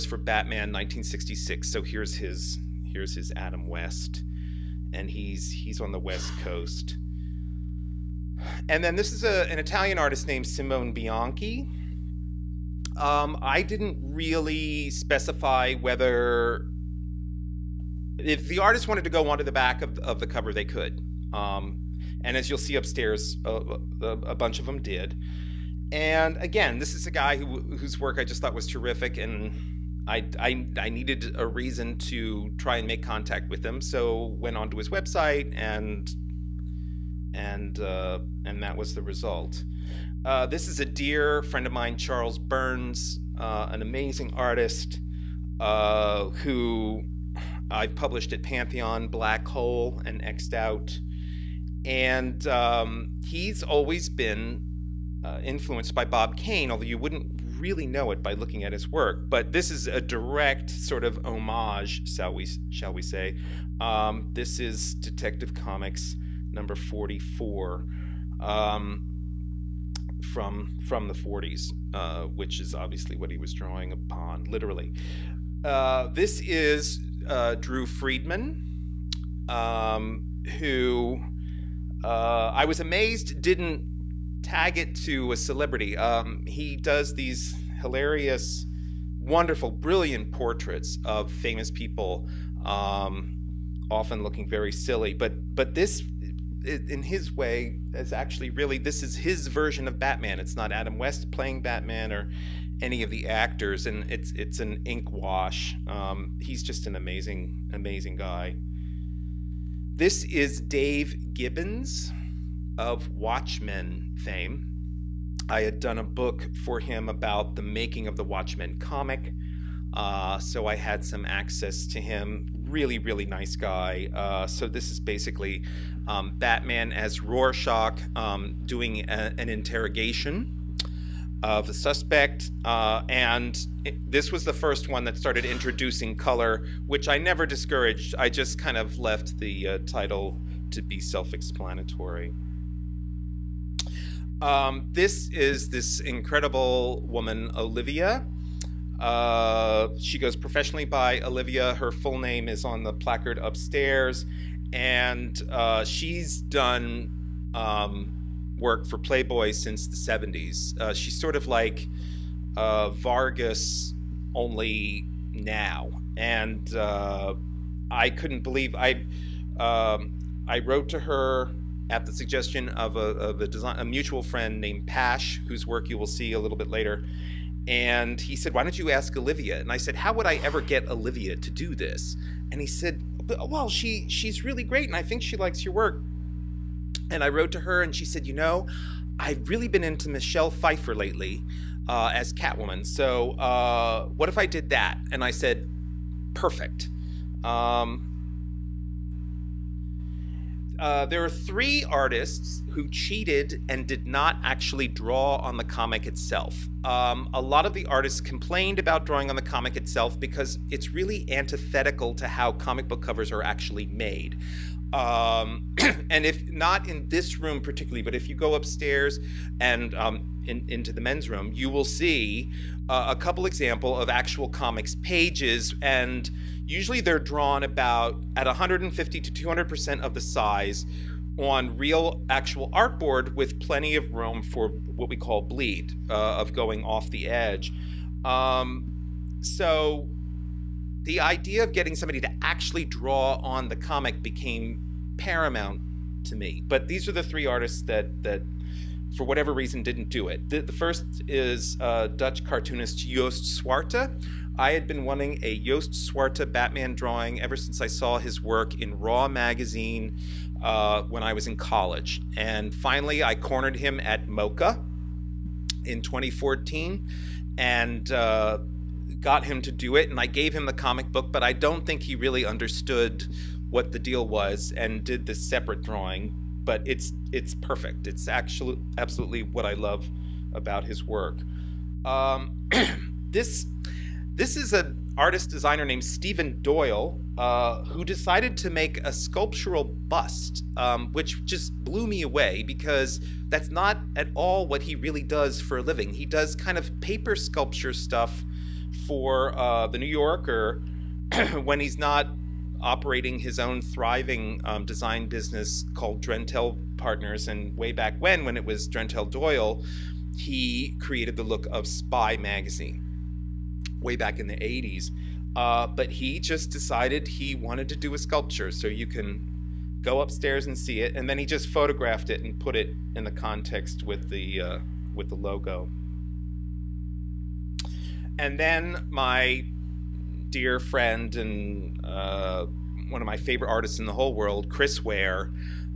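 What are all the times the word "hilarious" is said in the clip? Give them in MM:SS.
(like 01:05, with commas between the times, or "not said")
01:27.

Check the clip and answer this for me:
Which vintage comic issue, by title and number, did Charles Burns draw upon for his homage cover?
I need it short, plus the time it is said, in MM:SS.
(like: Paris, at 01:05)
Detective Comics 44, at 01:05.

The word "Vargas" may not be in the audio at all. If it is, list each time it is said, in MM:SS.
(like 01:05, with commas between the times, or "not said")
02:42.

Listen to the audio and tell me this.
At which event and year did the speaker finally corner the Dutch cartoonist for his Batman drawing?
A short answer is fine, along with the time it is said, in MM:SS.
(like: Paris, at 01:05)
MoCCA 2014, at 04:24.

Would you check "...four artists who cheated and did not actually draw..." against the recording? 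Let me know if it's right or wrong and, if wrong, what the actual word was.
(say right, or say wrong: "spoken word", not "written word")
wrong: "three", not "four".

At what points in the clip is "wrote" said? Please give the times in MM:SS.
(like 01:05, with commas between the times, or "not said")
02:50, 03:07.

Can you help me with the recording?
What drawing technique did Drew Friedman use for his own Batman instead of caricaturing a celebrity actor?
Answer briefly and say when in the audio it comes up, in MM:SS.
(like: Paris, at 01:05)
Ink wash, at 01:44.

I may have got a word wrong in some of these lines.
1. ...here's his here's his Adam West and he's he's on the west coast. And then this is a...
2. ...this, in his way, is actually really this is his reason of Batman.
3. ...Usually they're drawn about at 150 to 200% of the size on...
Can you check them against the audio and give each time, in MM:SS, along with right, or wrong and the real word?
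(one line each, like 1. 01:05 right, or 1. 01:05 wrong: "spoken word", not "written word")
1. 00:01 right
2. 01:35 wrong: "version", not "reason"
3. 03:46 right.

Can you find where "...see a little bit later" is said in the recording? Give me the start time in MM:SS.
02:56.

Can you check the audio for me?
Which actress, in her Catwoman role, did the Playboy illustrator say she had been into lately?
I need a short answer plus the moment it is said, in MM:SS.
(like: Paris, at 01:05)
Michelle Pfeiffer, at 03:10.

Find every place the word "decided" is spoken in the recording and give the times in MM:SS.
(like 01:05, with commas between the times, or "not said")
04:48, 05:16.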